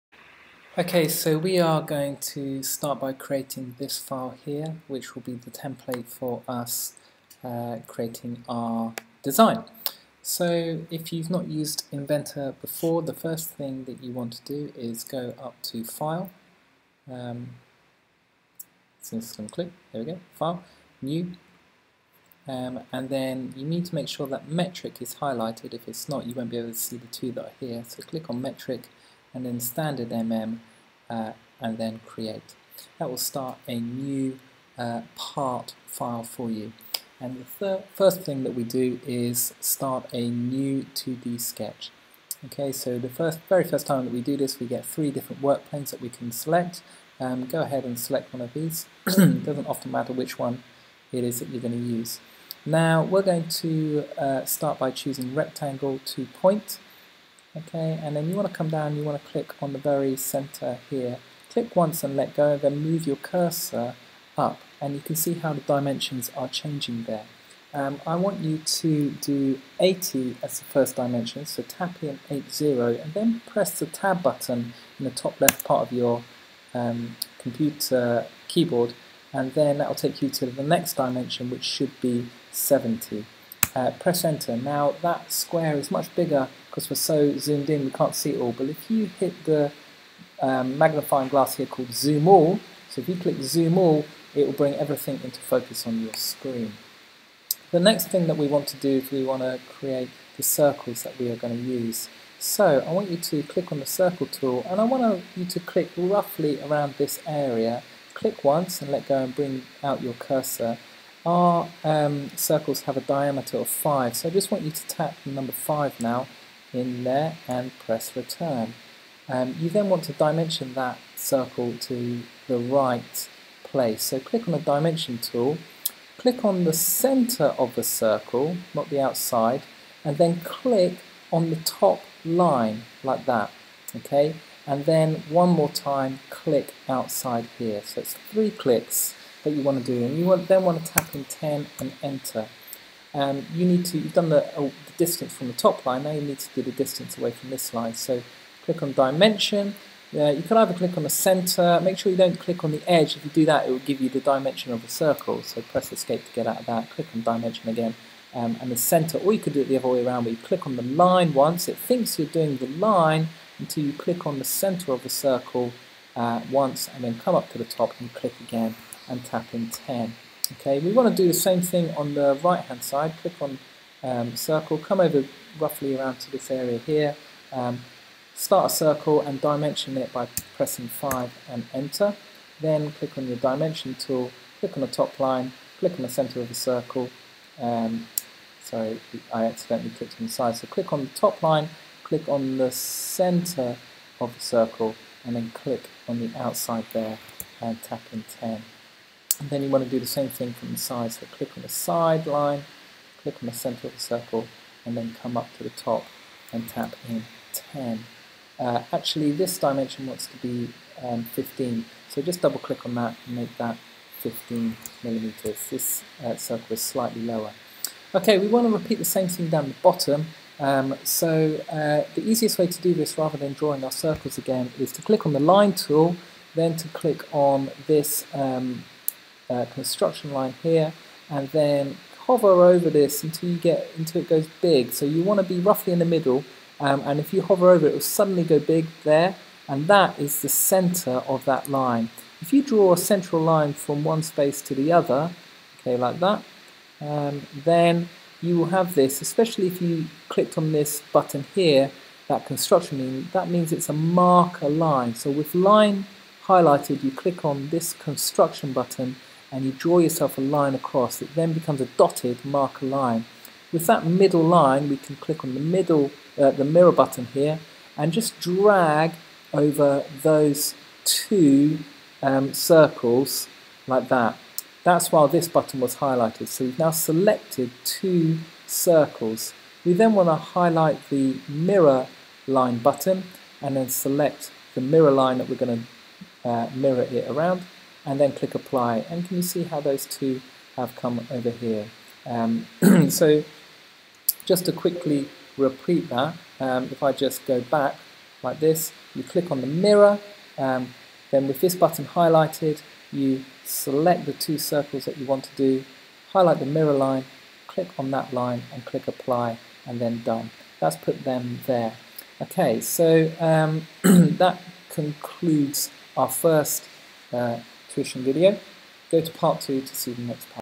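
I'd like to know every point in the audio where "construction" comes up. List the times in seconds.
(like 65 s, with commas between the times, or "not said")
229 s, 252 s, 257 s.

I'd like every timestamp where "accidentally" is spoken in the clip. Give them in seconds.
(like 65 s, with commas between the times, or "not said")
189 s.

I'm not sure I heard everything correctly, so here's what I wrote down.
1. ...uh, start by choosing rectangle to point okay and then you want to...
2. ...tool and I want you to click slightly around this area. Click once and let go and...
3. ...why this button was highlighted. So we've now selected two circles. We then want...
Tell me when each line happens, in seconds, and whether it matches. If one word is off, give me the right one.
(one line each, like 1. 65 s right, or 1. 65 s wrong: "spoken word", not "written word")
1. 54 s right
2. 104 s wrong: "roughly", not "slightly"
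3. 275 s right.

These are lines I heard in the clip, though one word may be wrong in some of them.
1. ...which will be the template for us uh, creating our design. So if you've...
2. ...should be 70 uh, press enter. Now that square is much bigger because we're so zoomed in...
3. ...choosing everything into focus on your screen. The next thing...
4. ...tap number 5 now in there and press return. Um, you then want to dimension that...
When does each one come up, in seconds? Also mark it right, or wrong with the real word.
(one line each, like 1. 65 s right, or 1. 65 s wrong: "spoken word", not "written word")
1. 4 s right
2. 81 s right
3. 94 s wrong: "bring", not "choosing"
4. 114 s right.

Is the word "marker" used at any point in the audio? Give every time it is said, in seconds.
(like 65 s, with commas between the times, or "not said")
253 s, 262 s.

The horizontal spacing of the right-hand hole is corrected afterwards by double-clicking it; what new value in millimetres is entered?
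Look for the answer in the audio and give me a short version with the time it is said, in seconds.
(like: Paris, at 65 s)
15, at 213 s.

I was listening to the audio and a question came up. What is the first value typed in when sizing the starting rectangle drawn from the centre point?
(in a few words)
80.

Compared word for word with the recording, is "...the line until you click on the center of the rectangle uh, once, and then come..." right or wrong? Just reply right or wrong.
wrong.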